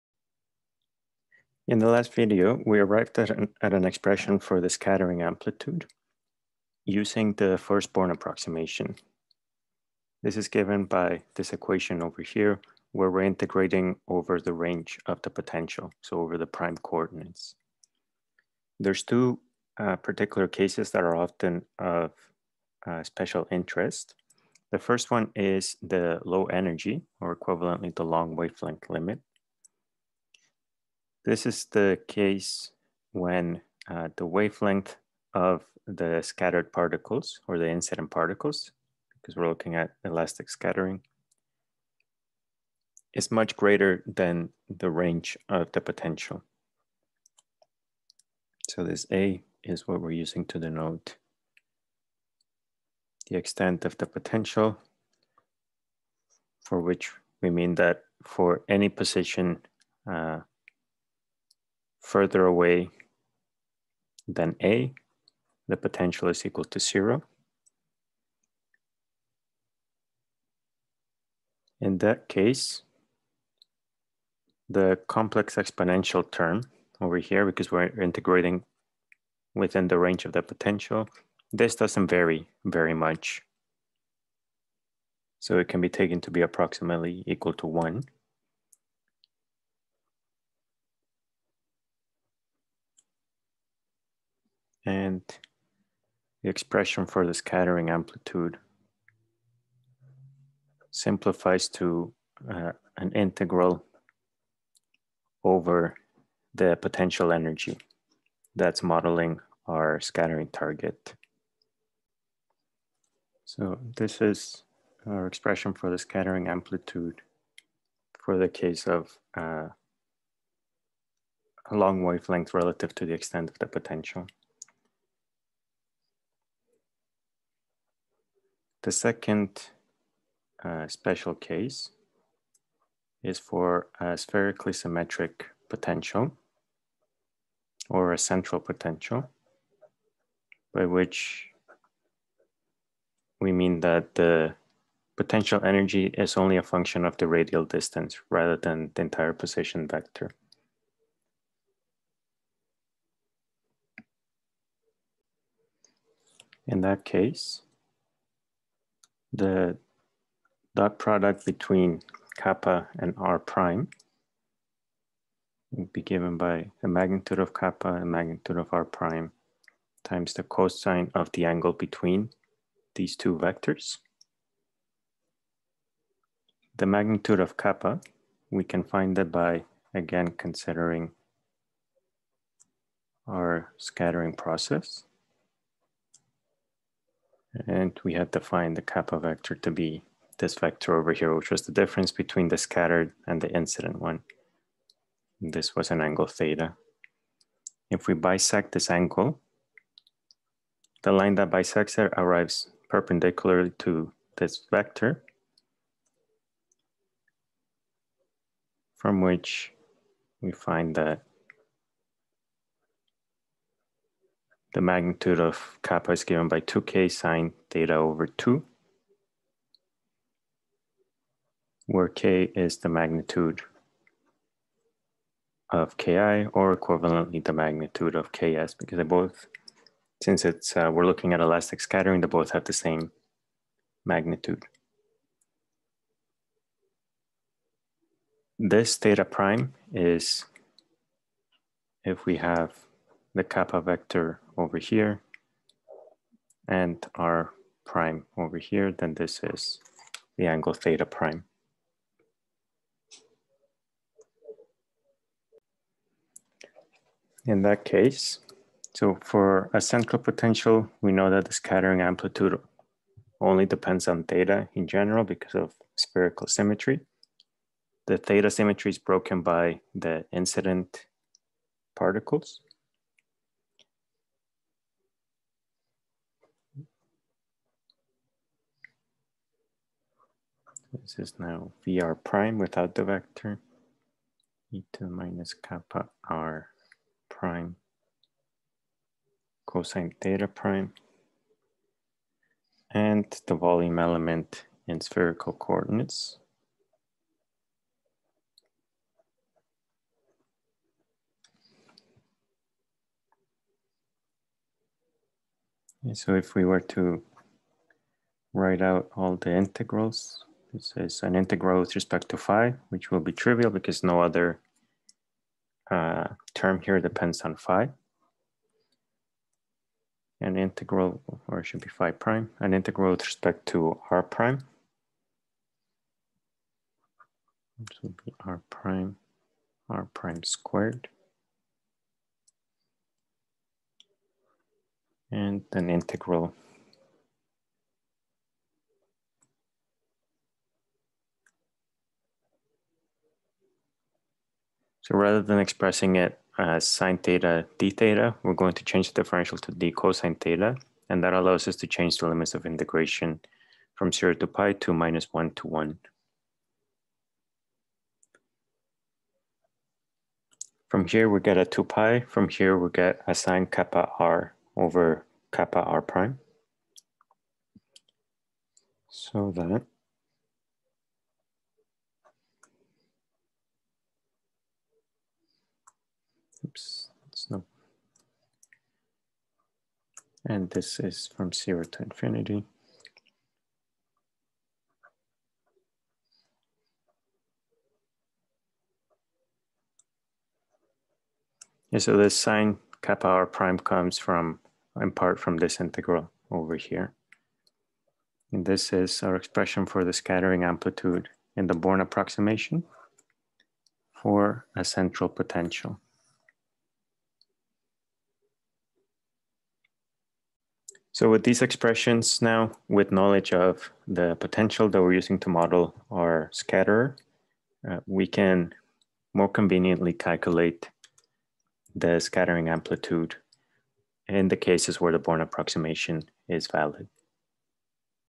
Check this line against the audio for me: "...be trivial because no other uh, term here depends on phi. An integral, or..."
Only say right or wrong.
right.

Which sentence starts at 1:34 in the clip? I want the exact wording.
and the expression for the scattering amplitude simplifies to uh, an integral over the potential energy that's modeling our scattering target.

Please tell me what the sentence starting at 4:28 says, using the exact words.
The theta symmetry is broken by the incident particles.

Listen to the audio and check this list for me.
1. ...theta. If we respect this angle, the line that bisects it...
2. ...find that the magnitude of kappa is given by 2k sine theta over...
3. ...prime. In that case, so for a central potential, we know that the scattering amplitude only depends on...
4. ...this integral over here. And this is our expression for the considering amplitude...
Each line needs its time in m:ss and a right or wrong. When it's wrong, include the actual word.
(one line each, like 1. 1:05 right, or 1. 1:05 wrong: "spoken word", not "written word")
1. 3:16 wrong: "bisect", not "respect"
2. 3:30 right
3. 4:11 right
4. 6:35 wrong: "scattering", not "considering".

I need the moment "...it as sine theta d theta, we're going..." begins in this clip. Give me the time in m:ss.
5:46.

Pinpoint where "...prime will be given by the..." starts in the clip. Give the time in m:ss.
2:43.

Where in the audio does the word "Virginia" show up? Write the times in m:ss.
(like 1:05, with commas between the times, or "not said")
not said.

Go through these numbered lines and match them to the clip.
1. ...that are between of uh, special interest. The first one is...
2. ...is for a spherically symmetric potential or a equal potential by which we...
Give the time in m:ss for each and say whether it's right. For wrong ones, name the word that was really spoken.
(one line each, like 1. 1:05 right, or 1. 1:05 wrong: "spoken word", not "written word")
1. 0:20 wrong: "often", not "between"
2. 2:13 wrong: "central", not "equal".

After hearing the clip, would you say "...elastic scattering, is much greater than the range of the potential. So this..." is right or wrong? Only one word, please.
right.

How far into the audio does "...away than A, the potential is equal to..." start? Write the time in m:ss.
1:02.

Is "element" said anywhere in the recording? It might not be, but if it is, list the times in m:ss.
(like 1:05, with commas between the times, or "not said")
4:53.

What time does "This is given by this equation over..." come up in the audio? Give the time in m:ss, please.
0:10.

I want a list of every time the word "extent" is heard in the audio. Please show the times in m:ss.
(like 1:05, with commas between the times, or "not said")
0:53, 2:03.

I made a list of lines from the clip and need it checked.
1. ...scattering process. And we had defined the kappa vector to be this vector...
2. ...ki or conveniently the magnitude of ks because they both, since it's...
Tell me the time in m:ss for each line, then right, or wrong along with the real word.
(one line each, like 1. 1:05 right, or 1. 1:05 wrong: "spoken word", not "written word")
1. 3:03 right
2. 3:45 wrong: "equivalently", not "conveniently".